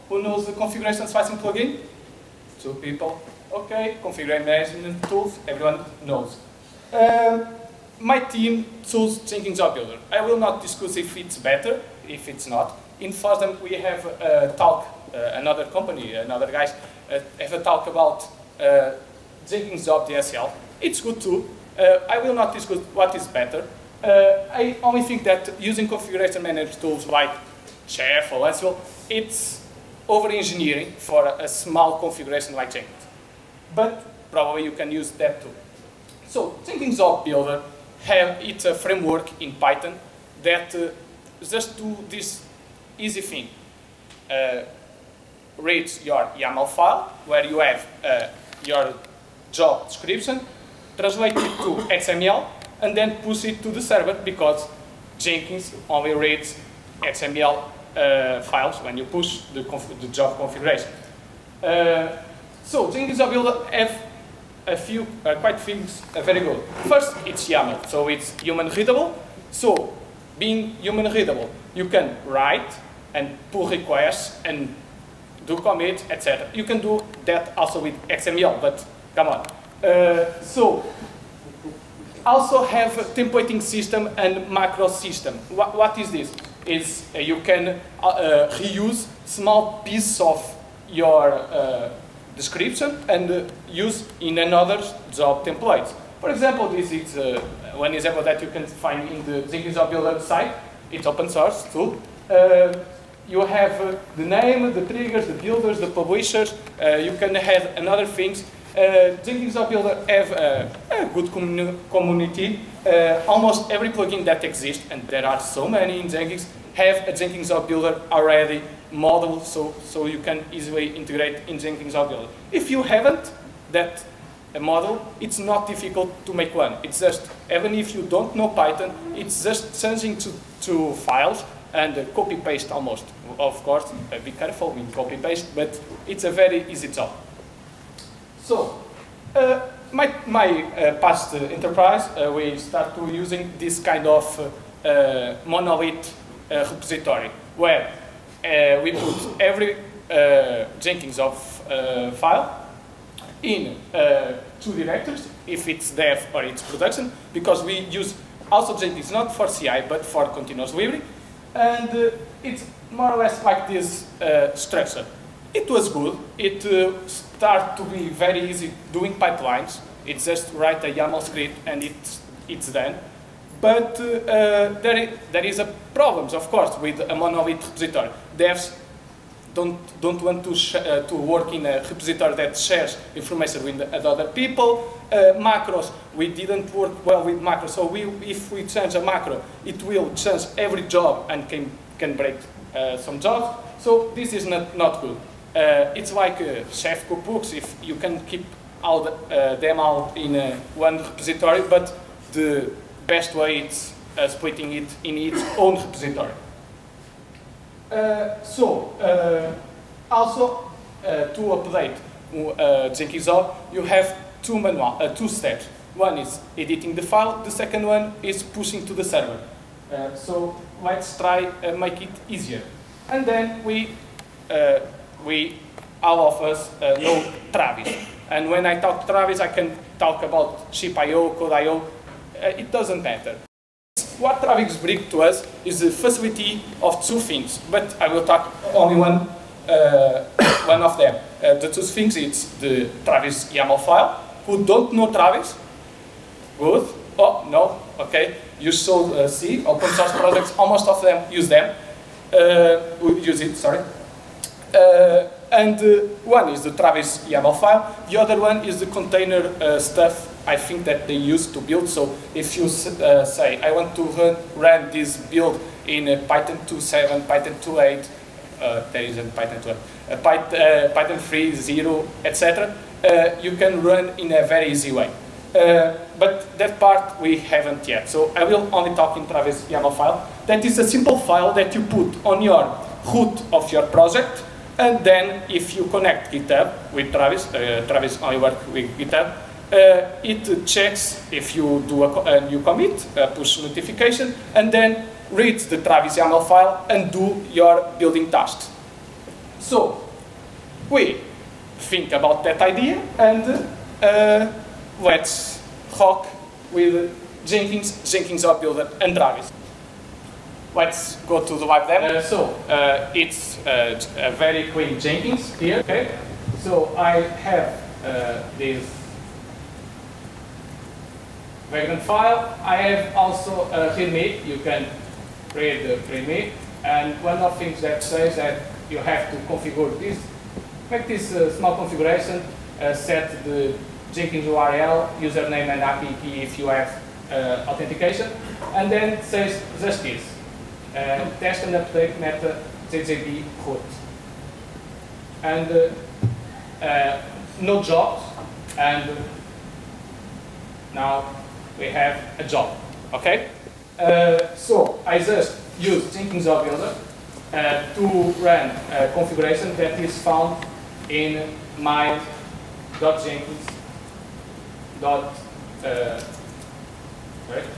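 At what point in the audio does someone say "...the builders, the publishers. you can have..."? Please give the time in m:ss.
1:45.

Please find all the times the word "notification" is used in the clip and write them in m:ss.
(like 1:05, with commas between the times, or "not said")
4:53.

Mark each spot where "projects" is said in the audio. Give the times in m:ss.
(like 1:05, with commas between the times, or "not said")
4:10, 4:43.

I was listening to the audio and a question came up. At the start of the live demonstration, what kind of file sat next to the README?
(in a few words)
Wagon file.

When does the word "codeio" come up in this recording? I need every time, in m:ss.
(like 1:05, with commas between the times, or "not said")
3:51.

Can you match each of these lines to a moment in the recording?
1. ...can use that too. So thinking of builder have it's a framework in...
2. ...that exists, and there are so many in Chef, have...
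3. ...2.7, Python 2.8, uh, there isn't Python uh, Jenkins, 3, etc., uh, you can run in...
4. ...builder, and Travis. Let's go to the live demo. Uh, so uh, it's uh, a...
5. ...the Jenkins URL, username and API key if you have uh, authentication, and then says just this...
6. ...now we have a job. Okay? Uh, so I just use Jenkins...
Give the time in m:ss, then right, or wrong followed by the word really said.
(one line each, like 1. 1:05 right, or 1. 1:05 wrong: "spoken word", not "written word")
1. 0:34 right
2. 1:54 wrong: "Jenkins", not "Chef"
3. 4:26 wrong: "Python", not "Jenkins"
4. 5:08 right
5. 5:33 right
6. 5:50 right.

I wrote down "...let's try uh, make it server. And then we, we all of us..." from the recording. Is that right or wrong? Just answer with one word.
wrong.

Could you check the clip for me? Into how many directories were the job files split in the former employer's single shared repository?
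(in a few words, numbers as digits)
2.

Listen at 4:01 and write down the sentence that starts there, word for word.
Uh, the two things it's the Travis YAML file.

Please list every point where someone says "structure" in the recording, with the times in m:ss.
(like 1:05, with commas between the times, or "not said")
2:44.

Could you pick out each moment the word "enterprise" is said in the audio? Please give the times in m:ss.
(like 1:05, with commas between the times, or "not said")
2:21.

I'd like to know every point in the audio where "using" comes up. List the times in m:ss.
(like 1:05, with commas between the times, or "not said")
0:25, 2:23.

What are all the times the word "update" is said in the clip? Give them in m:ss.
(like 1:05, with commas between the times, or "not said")
3:31, 5:41.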